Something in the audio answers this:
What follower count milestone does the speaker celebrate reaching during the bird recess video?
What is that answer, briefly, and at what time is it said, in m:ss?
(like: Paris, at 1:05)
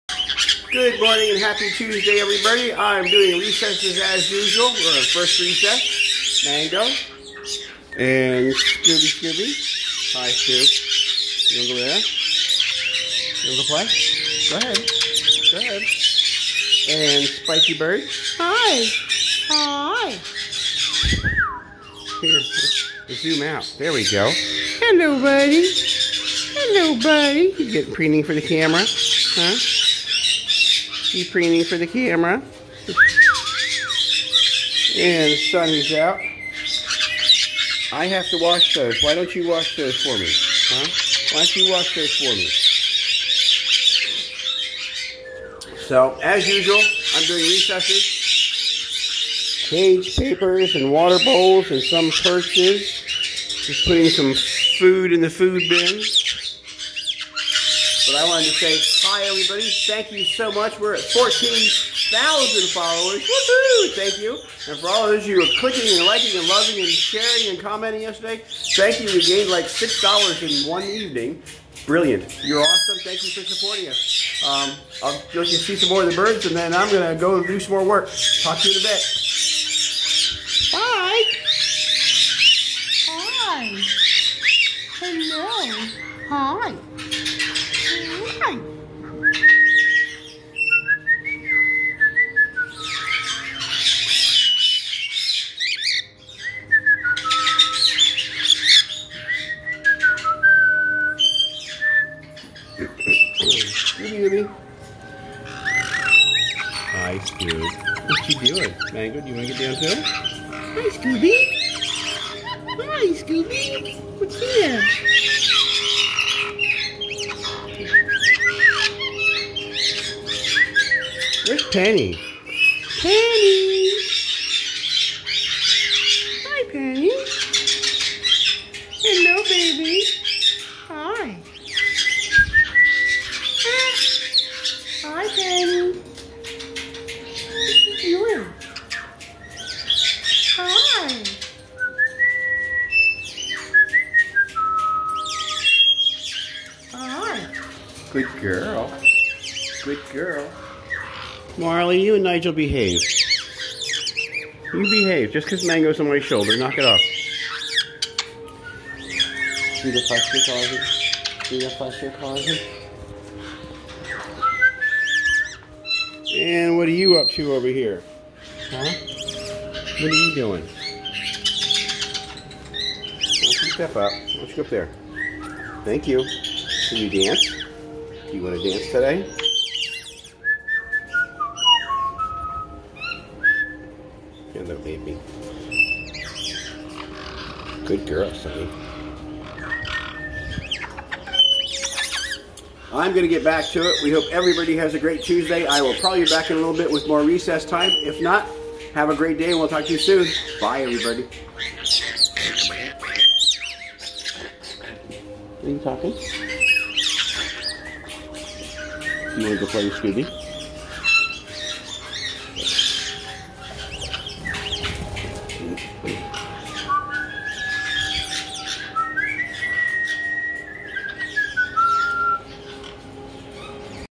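14,000, at 1:01.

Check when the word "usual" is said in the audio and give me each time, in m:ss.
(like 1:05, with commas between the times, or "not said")
0:04, 0:46.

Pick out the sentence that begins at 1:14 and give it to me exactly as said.
Um, I'll you see some more of the birds, and then I'm going to go do some more work.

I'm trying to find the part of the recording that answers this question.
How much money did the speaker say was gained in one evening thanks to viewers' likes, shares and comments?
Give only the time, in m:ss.
1:09.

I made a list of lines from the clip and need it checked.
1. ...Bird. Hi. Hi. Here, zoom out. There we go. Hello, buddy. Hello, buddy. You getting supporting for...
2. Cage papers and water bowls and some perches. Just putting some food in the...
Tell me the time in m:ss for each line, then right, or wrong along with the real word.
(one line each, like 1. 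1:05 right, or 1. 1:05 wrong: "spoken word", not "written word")
1. 0:17 wrong: "preening", not "supporting"
2. 0:49 right.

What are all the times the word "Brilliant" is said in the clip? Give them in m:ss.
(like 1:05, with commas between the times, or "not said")
1:11.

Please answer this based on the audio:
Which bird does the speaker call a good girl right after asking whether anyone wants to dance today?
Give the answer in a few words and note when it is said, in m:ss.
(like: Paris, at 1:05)
Sunny, at 3:08.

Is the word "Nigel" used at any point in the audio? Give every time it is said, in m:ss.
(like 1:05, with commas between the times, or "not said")
2:32.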